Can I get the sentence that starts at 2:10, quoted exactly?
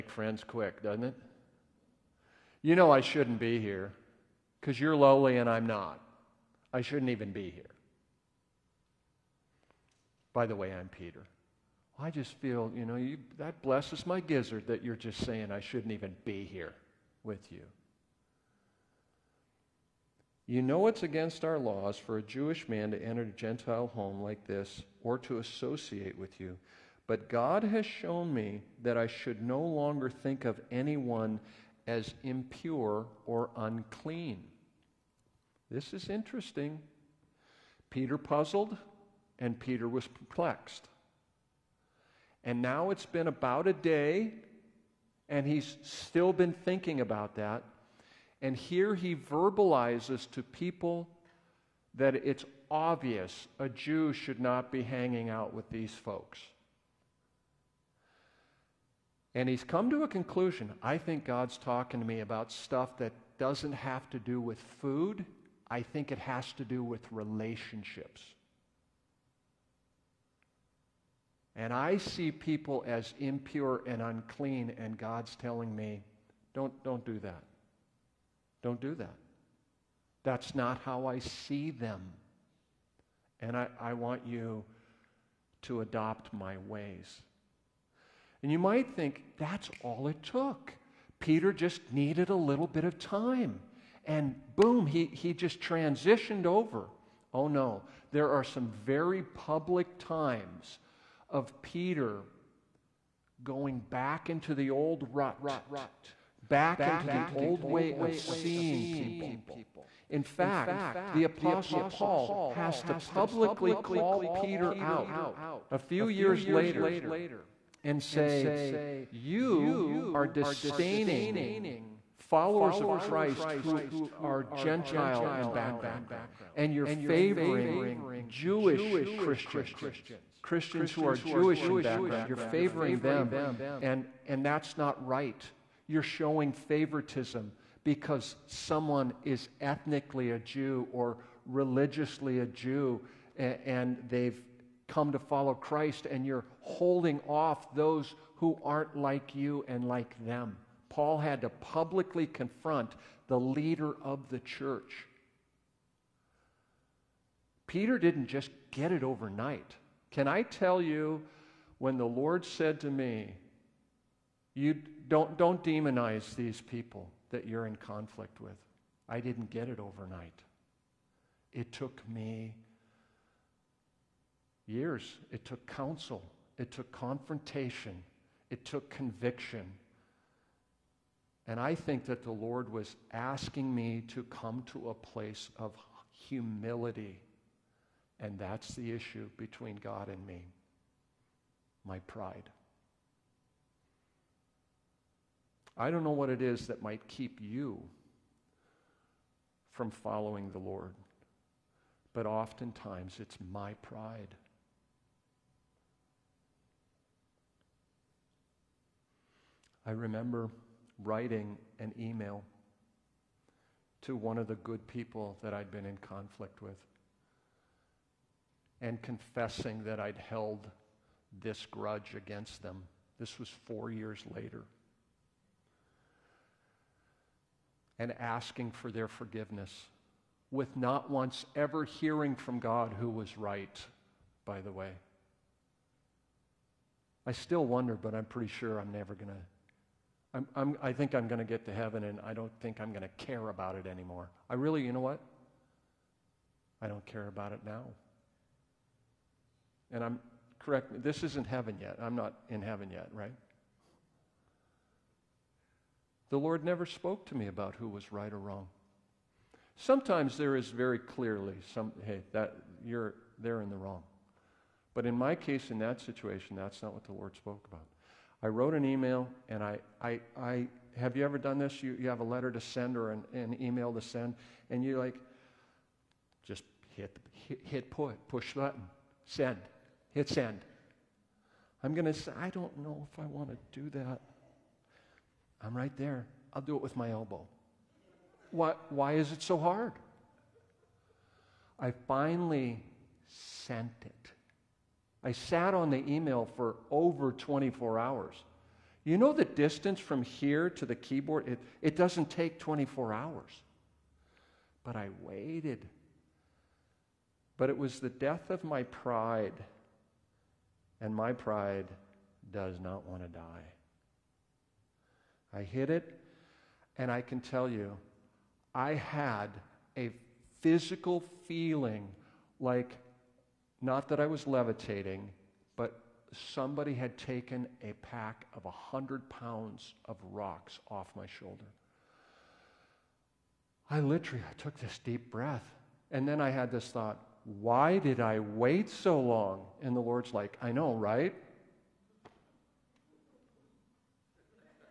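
Christians who are Jewish in background.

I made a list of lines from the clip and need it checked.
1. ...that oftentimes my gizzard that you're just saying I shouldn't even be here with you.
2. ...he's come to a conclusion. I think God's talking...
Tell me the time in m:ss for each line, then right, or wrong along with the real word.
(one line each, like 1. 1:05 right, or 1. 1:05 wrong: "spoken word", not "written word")
1. 0:13 wrong: "blesses", not "oftentimes"
2. 0:59 right.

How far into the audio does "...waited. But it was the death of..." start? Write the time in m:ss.
5:05.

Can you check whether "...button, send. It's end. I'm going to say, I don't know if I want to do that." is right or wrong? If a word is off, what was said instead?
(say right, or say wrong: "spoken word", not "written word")
right.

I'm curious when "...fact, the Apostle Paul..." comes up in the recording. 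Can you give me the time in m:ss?
1:50.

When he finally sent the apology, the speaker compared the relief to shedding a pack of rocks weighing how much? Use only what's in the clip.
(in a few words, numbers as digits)
100 pounds.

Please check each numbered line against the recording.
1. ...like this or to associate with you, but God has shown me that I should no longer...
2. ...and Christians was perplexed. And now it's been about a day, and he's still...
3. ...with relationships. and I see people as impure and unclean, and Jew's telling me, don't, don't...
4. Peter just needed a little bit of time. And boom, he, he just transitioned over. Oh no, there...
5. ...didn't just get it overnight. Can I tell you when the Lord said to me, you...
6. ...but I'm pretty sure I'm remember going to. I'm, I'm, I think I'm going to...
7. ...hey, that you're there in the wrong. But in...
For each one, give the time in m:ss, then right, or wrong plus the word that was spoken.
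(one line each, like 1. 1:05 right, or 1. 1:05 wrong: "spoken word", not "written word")
1. 0:24 right
2. 0:39 wrong: "Peter", not "Christians"
3. 1:06 wrong: "God", not "Jew"
4. 1:31 right
5. 2:37 right
6. 3:57 wrong: "never", not "remember"
7. 4:22 right.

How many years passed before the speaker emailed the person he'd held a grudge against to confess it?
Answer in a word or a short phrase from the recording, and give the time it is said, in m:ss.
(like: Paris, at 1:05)
4 years, at 3:43.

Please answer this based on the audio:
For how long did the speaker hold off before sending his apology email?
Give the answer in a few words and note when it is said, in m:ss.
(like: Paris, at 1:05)
Over 24 hours, at 4:56.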